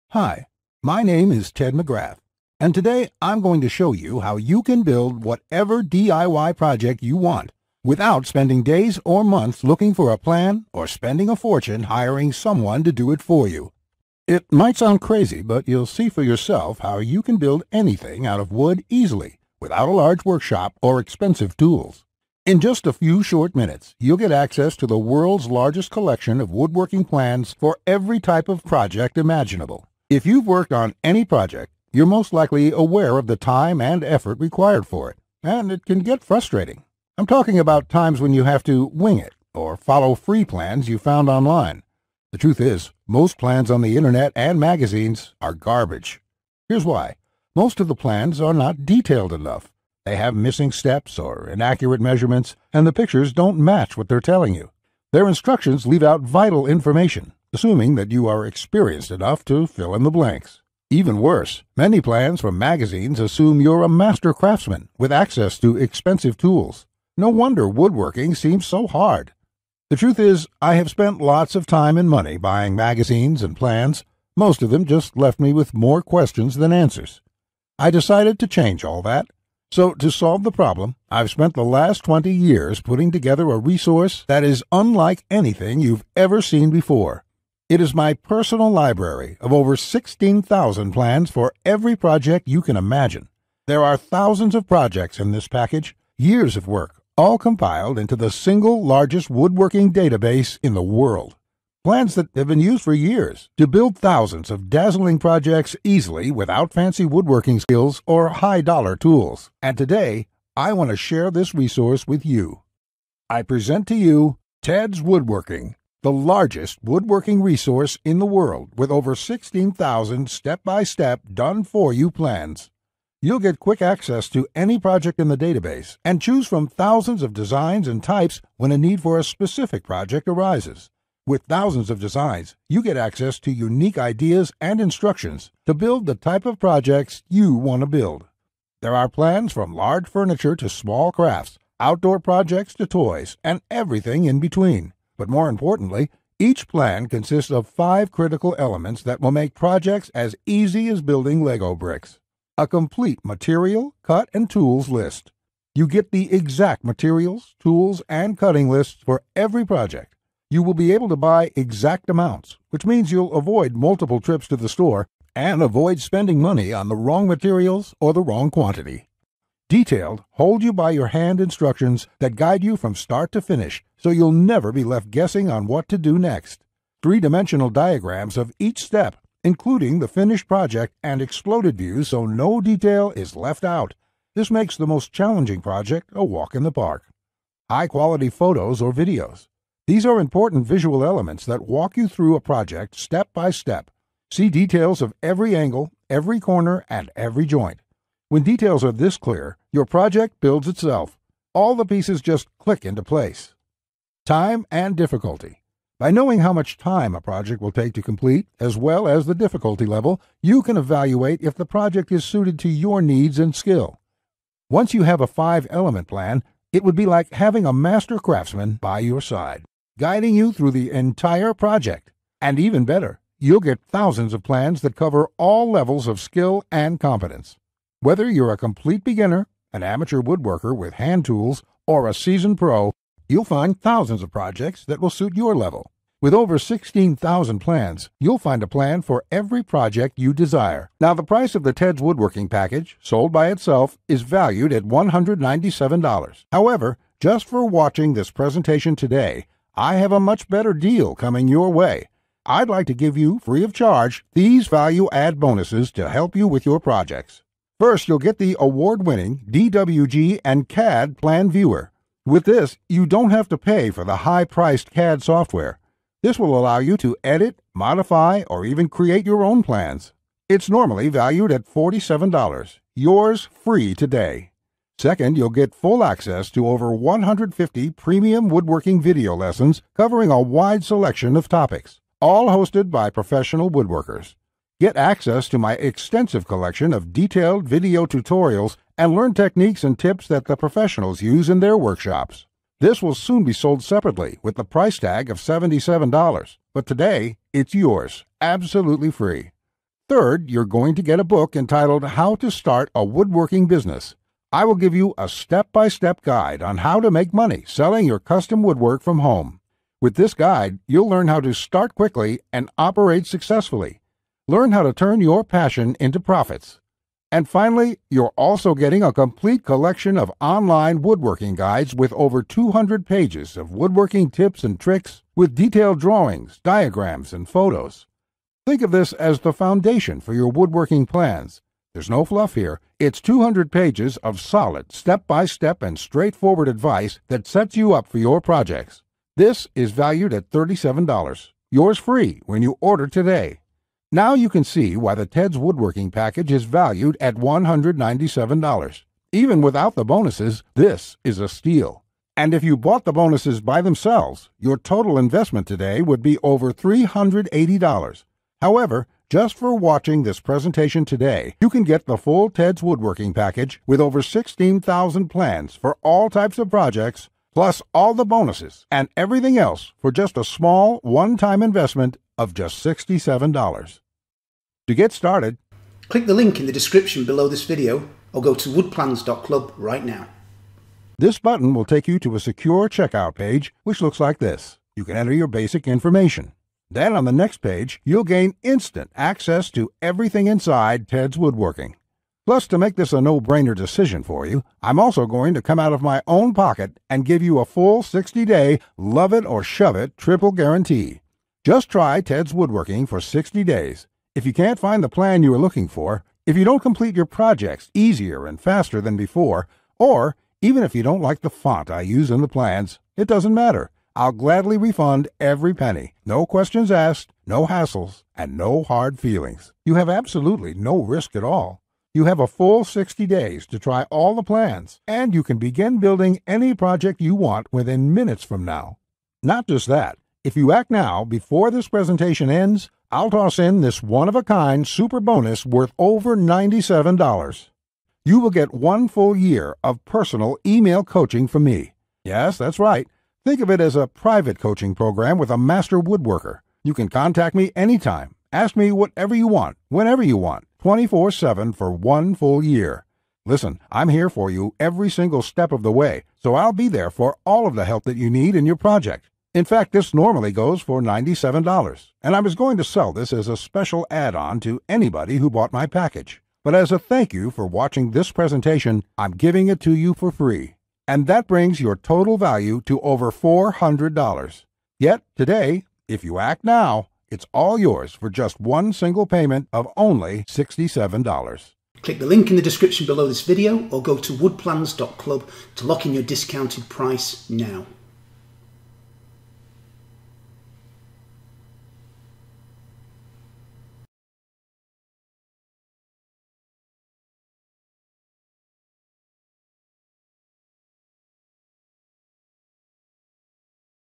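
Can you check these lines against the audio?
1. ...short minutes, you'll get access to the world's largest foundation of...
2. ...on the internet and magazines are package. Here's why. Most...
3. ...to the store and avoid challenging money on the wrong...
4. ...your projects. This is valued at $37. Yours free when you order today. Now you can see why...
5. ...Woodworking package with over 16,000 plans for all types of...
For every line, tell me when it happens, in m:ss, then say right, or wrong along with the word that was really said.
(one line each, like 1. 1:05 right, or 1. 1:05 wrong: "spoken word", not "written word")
1. 0:23 wrong: "collection", not "foundation"
2. 0:43 wrong: "garbage", not "package"
3. 2:44 wrong: "spending", not "challenging"
4. 5:38 right
5. 6:02 right.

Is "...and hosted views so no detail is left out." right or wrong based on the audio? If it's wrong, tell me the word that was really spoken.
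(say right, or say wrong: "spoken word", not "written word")
wrong: "exploded", not "hosted".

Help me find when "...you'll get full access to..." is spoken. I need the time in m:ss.
4:35.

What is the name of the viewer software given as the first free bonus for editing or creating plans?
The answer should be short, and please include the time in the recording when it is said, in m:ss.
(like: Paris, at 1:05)
DWG and CAD Plan Viewer, at 4:19.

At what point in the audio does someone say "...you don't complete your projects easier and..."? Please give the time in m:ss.
6:46.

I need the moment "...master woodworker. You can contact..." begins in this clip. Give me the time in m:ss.
7:25.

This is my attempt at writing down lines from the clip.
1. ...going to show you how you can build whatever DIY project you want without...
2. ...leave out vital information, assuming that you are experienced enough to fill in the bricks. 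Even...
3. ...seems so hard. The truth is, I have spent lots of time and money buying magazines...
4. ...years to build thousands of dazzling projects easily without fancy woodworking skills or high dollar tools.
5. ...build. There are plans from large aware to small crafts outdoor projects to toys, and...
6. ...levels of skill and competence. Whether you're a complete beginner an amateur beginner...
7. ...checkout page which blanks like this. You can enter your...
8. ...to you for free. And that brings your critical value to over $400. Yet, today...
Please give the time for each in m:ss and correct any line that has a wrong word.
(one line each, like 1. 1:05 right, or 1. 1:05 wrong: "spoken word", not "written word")
1. 0:03 right
2. 0:55 wrong: "blanks", not "bricks"
3. 1:08 right
4. 1:42 right
5. 2:17 wrong: "furniture", not "aware"
6. 3:45 wrong: "woodworker", not "beginner"
7. 6:22 wrong: "looks", not "blanks"
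8. 7:49 wrong: "total", not "critical".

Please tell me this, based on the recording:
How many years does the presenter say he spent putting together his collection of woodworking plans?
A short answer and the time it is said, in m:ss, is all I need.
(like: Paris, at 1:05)
20, at 1:22.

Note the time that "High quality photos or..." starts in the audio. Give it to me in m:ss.
3:07.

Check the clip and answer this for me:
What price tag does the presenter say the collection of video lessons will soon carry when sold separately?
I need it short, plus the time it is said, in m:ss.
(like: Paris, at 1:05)
$77, at 4:55.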